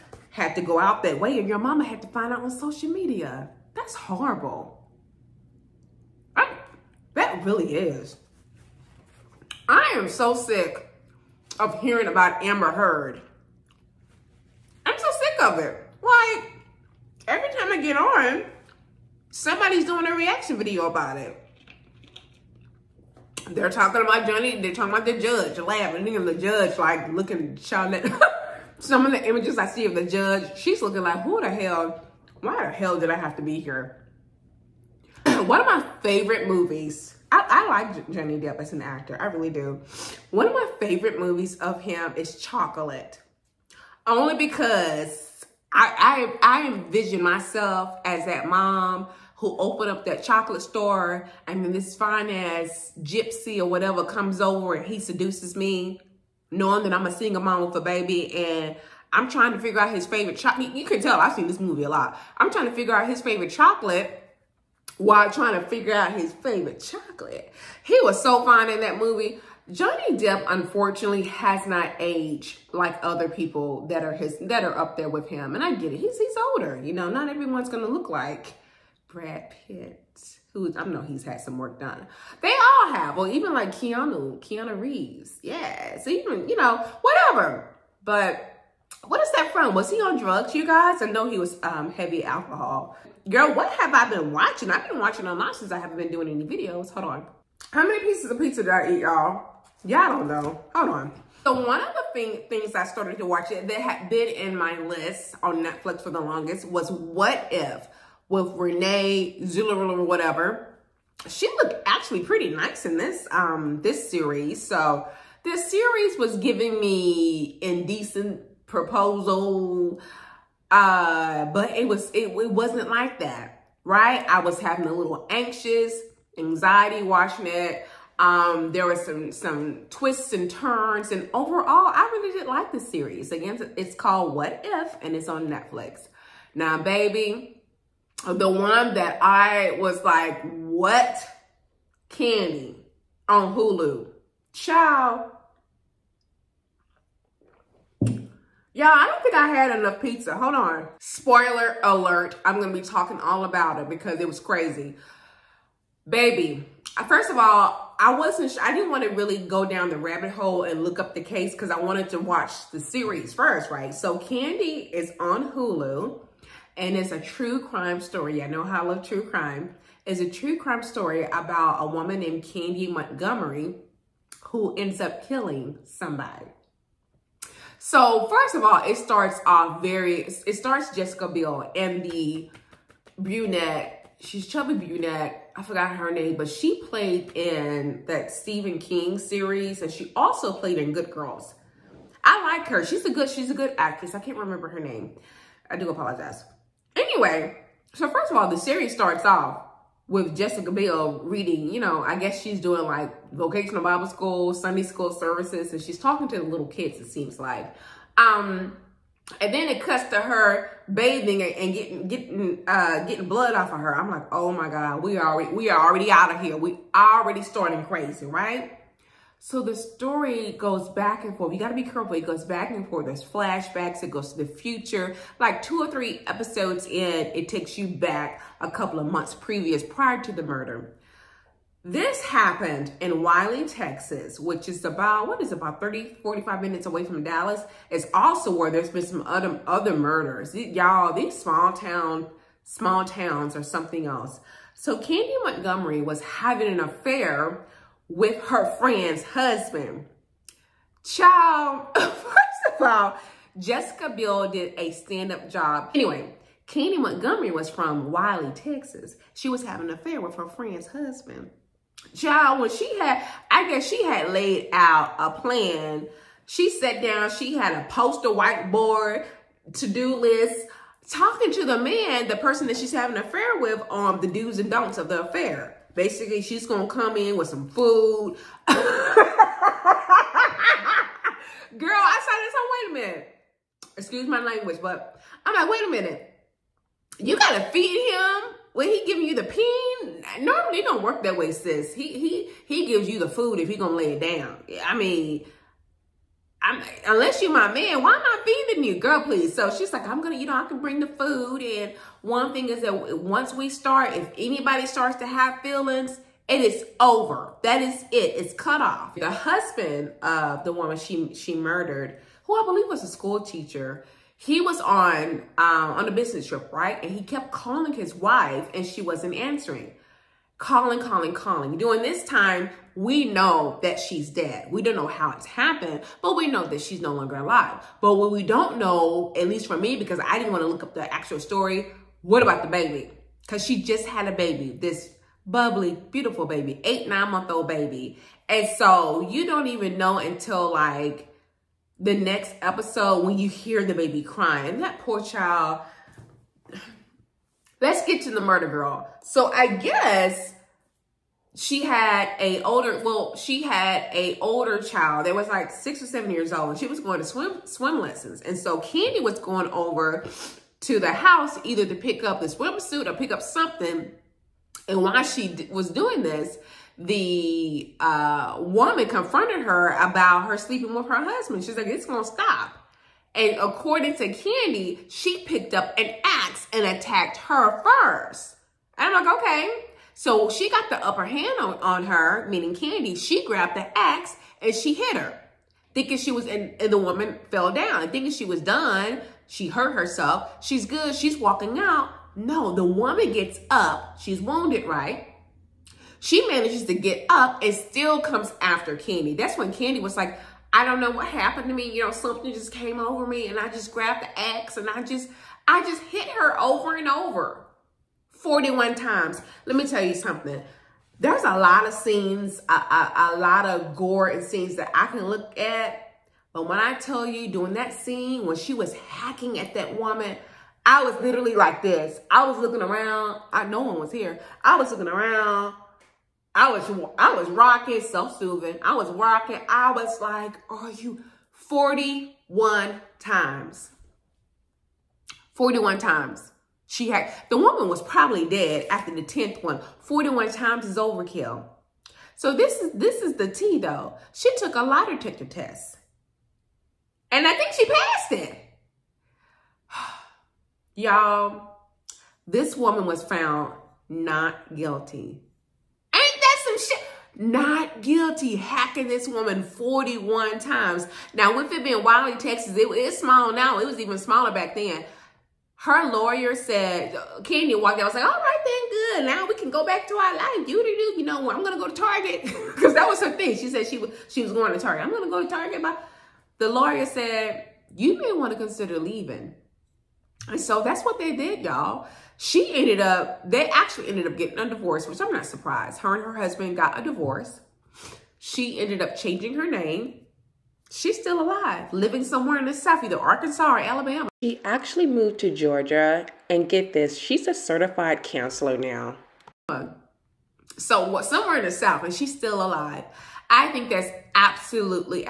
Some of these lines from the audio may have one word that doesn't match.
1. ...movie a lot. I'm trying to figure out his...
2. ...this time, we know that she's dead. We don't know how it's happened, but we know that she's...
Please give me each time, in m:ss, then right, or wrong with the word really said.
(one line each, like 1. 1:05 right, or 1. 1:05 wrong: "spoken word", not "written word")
1. 1:01 right
2. 5:22 right.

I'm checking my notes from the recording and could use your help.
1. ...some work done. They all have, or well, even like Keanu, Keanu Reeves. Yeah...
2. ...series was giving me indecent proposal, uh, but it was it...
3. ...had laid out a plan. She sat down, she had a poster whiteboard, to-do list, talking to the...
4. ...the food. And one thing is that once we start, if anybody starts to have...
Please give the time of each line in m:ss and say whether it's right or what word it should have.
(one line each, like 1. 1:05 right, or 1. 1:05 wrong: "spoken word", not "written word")
1. 1:21 right
2. 1:55 right
3. 4:24 right
4. 5:01 right.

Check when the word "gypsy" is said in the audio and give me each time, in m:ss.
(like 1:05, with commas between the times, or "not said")
0:53.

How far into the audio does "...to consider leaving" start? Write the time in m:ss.
7:58.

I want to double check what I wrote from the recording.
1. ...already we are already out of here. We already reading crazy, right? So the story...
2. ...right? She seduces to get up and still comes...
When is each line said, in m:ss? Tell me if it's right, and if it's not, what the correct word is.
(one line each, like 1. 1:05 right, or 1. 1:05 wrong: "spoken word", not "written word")
1. 3:35 wrong: "starting", not "reading"
2. 6:34 wrong: "manages", not "seduces".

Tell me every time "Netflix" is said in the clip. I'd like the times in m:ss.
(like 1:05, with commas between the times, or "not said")
1:45, 2:15.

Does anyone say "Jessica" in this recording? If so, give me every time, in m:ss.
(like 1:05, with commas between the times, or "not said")
3:00, 3:20, 4:13.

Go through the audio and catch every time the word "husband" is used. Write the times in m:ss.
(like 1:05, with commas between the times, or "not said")
4:09, 4:20, 5:09, 6:11, 8:06.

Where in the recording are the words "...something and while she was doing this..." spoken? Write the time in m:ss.
6:03.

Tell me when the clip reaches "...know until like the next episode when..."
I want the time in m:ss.
5:39.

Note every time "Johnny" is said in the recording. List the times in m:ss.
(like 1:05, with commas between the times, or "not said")
0:24, 0:38, 1:09.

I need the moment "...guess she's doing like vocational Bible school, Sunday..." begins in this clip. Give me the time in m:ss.
3:22.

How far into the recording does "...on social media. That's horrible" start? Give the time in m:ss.
0:02.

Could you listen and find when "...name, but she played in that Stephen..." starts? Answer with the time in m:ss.
3:06.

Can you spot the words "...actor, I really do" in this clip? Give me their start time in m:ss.
0:38.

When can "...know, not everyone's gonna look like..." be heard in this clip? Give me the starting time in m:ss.
1:16.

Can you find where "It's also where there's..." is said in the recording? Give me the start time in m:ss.
3:57.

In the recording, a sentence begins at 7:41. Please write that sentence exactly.
Now, with it being Wylie, Texas, it, it's small now.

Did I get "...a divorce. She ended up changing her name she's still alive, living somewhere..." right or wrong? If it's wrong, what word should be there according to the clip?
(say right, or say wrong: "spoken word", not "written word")
right.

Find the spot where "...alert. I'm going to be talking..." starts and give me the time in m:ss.
2:31.